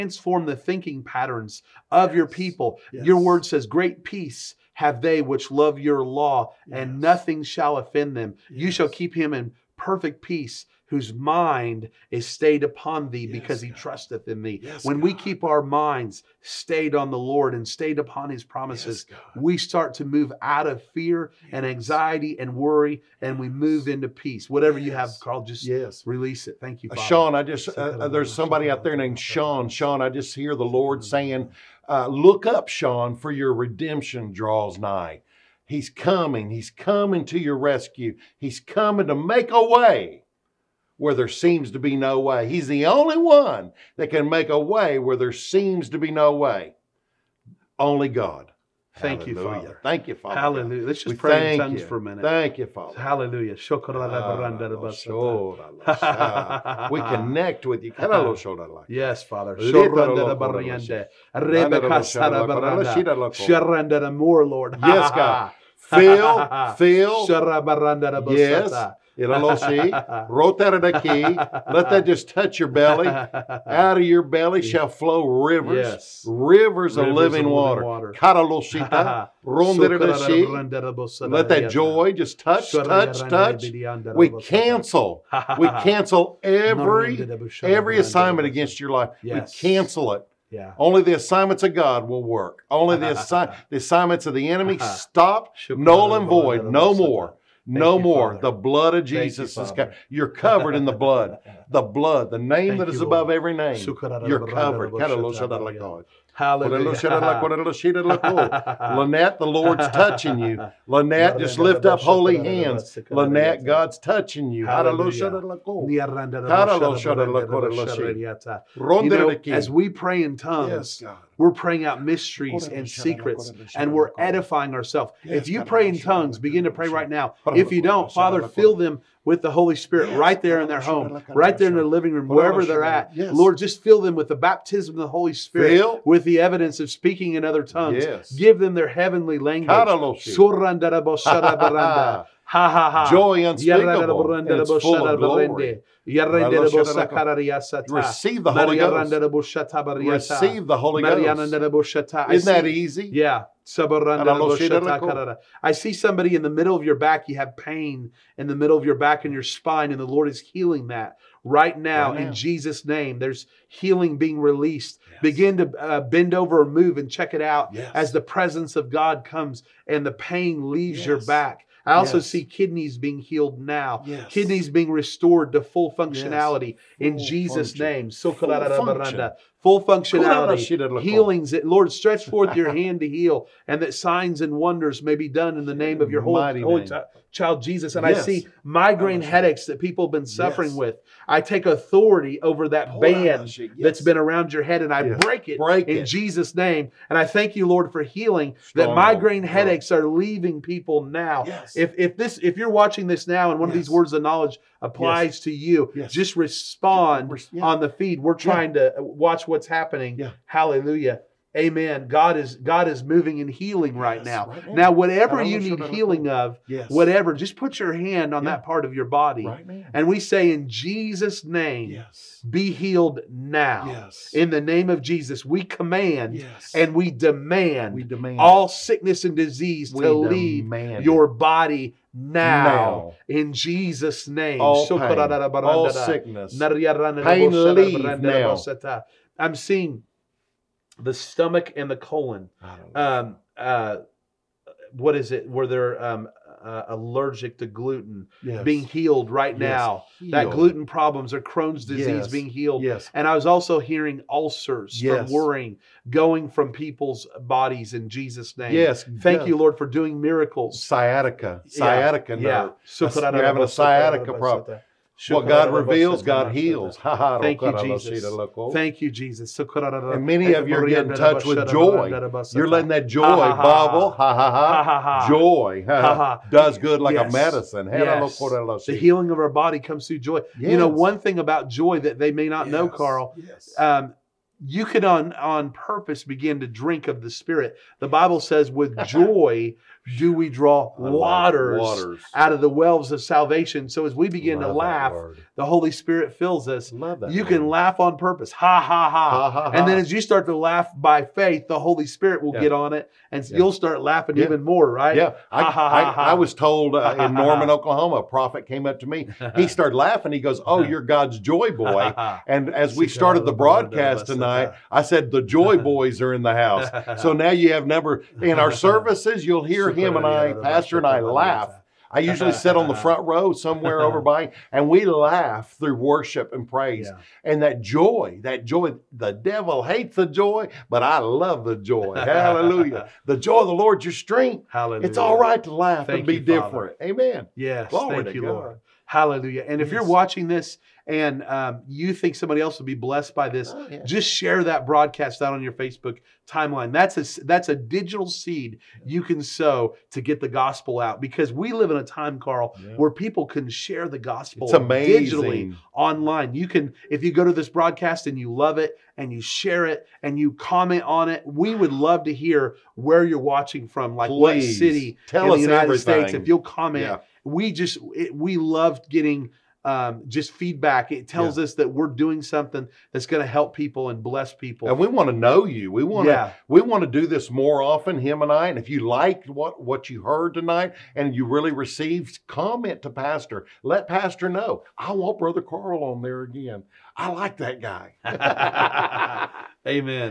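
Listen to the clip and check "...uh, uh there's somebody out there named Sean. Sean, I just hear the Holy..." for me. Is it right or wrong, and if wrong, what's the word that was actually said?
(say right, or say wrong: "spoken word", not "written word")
wrong: "Lord", not "Holy".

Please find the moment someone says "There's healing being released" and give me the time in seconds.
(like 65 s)
163 s.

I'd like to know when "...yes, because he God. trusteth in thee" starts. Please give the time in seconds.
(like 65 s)
13 s.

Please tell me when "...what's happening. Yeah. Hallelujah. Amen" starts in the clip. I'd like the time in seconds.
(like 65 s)
209 s.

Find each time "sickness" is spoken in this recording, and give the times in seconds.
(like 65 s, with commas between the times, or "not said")
228 s, 235 s.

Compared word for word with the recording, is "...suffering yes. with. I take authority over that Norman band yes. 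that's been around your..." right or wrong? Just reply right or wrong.
wrong.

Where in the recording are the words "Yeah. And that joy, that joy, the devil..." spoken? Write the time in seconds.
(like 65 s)
327 s.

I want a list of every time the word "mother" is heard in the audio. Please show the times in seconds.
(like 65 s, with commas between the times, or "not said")
not said.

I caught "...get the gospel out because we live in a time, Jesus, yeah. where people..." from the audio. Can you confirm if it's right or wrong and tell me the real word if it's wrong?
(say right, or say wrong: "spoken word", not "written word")
wrong: "Carl", not "Jesus".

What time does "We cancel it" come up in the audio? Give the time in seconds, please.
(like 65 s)
89 s.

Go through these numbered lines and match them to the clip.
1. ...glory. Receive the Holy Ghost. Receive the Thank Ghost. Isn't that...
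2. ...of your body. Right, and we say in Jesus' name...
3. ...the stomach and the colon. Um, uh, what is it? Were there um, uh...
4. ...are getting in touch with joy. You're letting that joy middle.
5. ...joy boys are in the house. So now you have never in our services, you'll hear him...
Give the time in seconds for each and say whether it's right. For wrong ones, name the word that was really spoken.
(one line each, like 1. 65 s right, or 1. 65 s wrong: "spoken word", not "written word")
1. 145 s wrong: "Holy", not "Thank"
2. 218 s right
3. 240 s right
4. 270 s wrong: "bubble", not "middle"
5. 315 s right.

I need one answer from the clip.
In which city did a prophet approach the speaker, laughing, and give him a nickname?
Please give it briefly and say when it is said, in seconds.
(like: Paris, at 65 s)
Norman, Oklahoma, at 307 s.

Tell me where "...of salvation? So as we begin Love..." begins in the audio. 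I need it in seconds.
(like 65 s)
293 s.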